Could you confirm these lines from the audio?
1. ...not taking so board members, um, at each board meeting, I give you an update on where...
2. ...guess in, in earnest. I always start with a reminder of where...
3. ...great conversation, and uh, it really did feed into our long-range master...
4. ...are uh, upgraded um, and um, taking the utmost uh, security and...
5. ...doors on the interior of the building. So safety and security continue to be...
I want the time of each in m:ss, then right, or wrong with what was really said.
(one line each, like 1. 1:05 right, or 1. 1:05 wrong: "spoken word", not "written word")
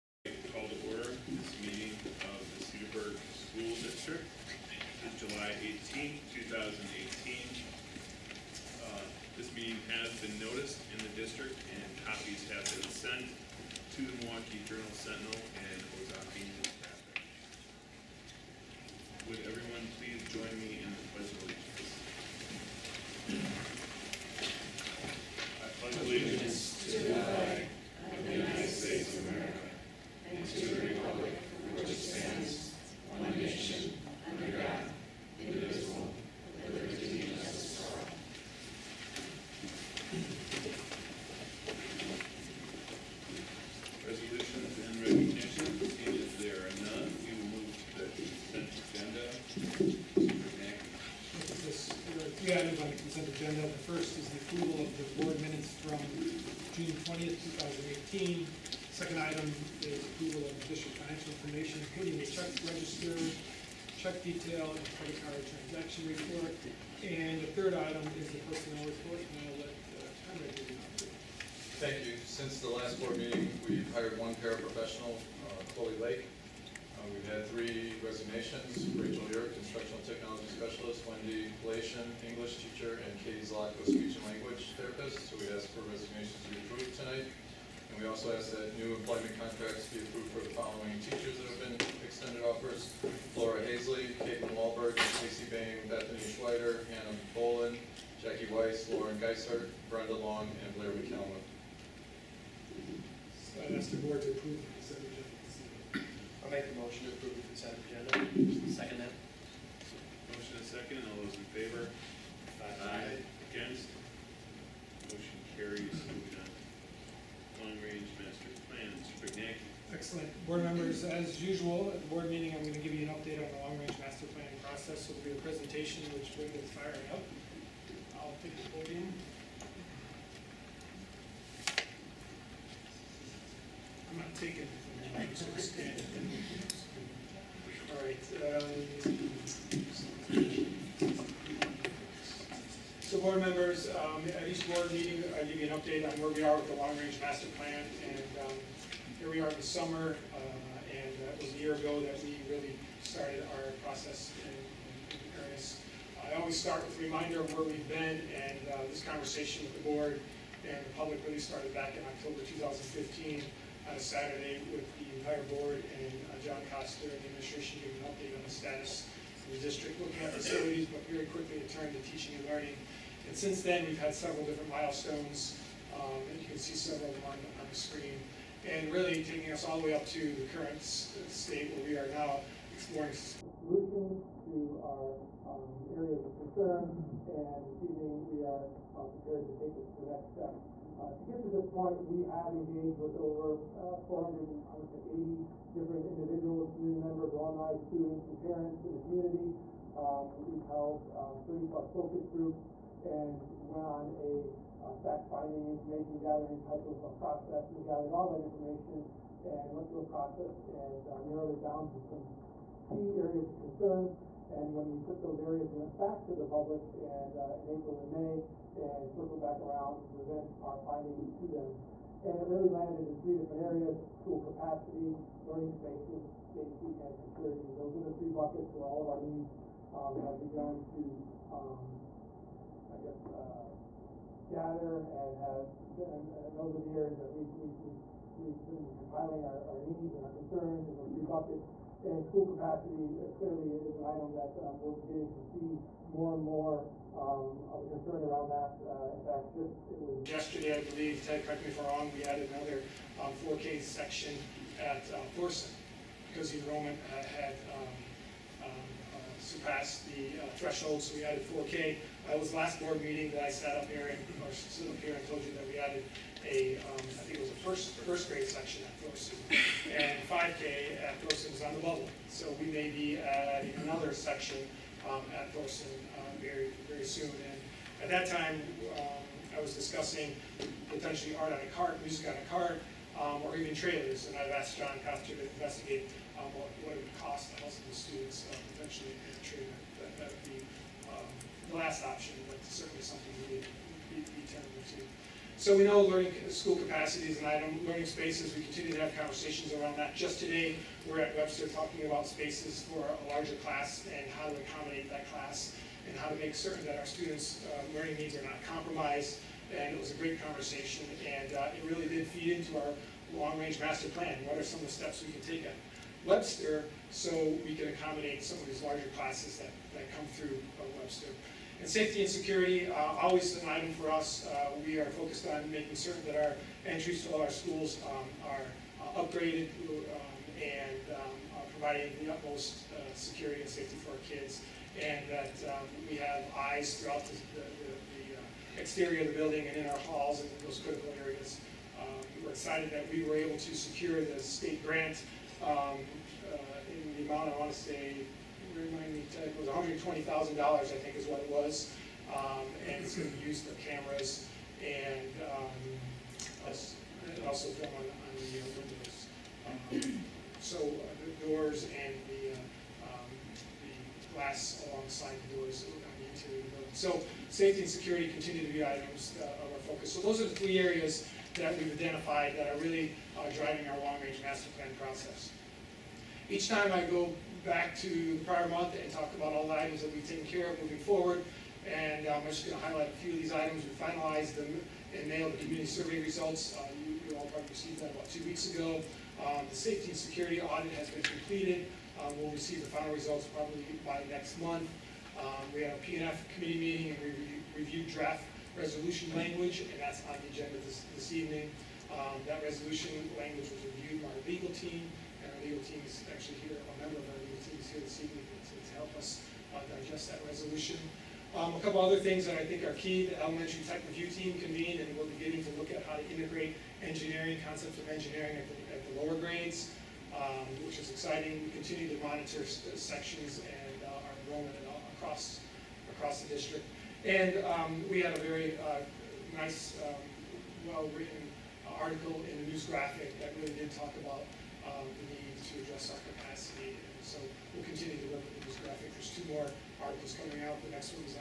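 1. 2:14 right
2. 2:33 wrong: "process", not "guess"
3. 5:10 right
4. 5:28 wrong: "providing", not "taking"
5. 6:05 right.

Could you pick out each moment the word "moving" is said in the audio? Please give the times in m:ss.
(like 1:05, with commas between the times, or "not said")
1:56, 6:20.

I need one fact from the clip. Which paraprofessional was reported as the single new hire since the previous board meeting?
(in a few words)
Chloe Lake.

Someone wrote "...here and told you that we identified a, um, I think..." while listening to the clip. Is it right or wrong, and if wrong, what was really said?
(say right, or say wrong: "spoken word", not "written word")
wrong: "added", not "identified".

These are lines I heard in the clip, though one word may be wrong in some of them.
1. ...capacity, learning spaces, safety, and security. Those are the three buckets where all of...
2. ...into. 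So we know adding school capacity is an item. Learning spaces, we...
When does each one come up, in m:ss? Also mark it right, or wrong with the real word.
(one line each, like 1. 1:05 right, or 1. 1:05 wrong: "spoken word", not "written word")
1. 3:44 right
2. 4:54 wrong: "learning", not "adding".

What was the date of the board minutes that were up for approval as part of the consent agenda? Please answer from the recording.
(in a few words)
June 20th, 2018.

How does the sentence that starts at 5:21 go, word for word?
And safety and security, uh, always an item for us.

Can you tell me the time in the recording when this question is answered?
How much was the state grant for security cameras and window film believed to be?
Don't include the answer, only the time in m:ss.
5:49.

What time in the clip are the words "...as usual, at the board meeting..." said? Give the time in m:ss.
2:01.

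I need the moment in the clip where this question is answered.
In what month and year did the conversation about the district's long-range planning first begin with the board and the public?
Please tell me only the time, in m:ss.
2:42.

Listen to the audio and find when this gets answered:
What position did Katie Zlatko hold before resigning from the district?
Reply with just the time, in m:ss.
1:23.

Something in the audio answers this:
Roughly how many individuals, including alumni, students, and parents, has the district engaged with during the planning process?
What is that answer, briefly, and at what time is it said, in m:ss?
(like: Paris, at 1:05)
480, at 3:14.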